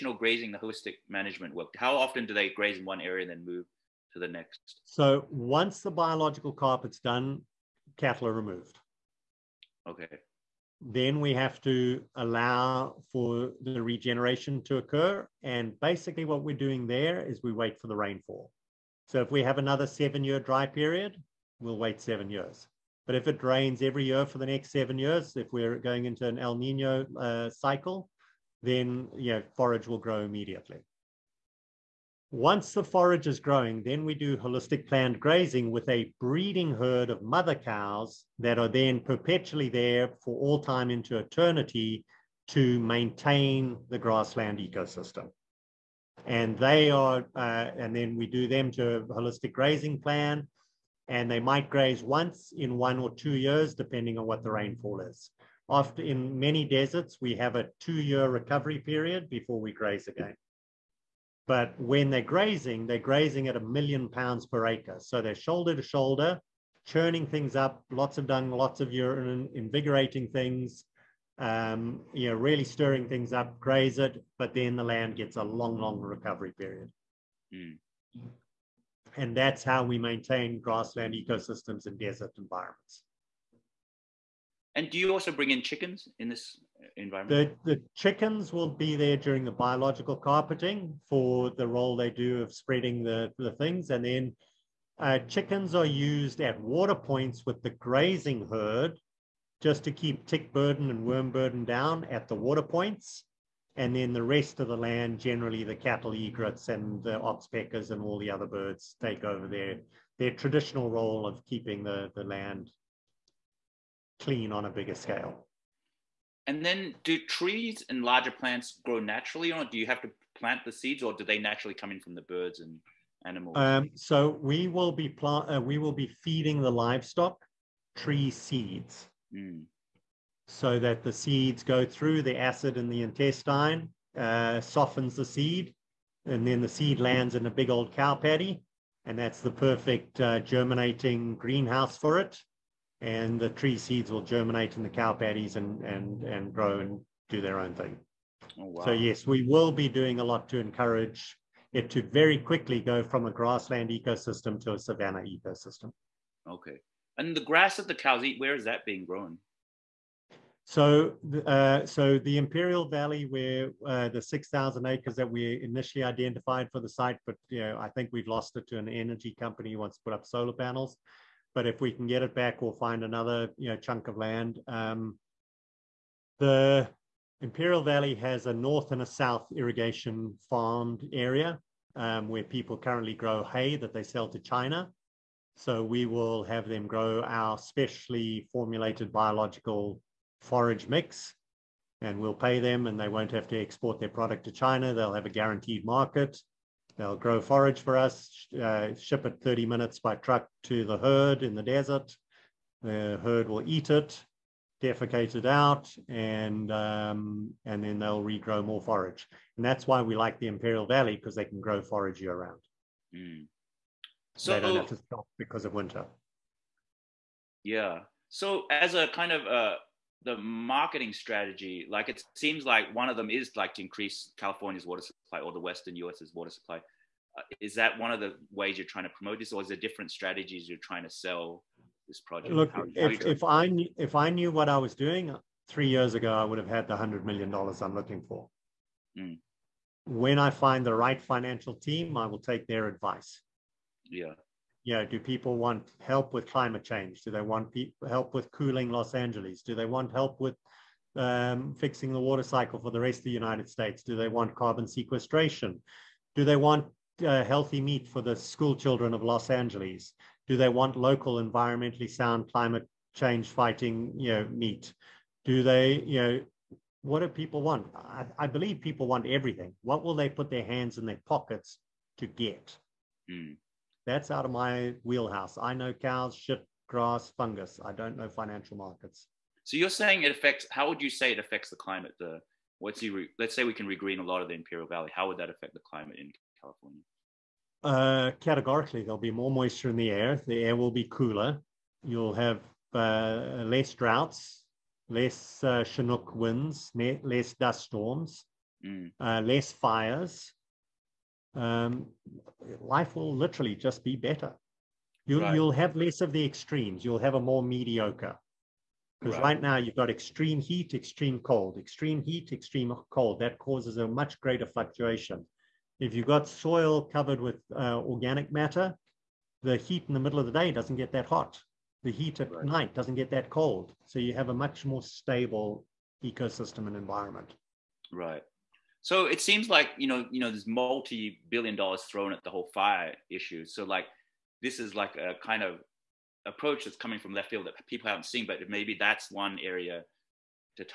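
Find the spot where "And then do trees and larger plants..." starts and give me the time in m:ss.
1:56.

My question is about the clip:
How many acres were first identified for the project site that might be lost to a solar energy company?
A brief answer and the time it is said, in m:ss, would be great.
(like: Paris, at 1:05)
6,000, at 2:44.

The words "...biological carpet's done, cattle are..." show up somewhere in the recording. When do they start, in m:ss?
0:05.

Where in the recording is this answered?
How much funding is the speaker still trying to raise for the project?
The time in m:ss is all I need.
3:56.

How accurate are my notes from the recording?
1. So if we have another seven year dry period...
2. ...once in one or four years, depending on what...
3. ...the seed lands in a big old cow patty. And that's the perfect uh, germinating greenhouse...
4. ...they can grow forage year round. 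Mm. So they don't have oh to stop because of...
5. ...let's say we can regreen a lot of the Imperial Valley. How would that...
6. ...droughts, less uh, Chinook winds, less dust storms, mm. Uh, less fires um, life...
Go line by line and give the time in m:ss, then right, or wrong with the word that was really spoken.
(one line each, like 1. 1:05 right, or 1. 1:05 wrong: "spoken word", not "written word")
1. 0:19 right
2. 0:52 wrong: "two", not "four"
3. 2:16 right
4. 3:31 right
5. 4:43 right
6. 4:53 right.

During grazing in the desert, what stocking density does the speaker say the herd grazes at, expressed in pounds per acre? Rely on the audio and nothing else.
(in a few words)
1,000,000 pounds per acre.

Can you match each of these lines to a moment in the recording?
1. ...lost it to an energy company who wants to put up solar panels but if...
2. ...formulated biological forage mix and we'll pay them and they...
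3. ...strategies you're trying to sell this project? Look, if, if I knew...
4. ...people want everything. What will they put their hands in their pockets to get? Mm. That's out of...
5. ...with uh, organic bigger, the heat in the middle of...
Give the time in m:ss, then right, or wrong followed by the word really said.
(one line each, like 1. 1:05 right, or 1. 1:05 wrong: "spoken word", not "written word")
1. 2:48 right
2. 3:08 right
3. 3:50 right
4. 4:28 right
5. 5:17 wrong: "matter", not "bigger".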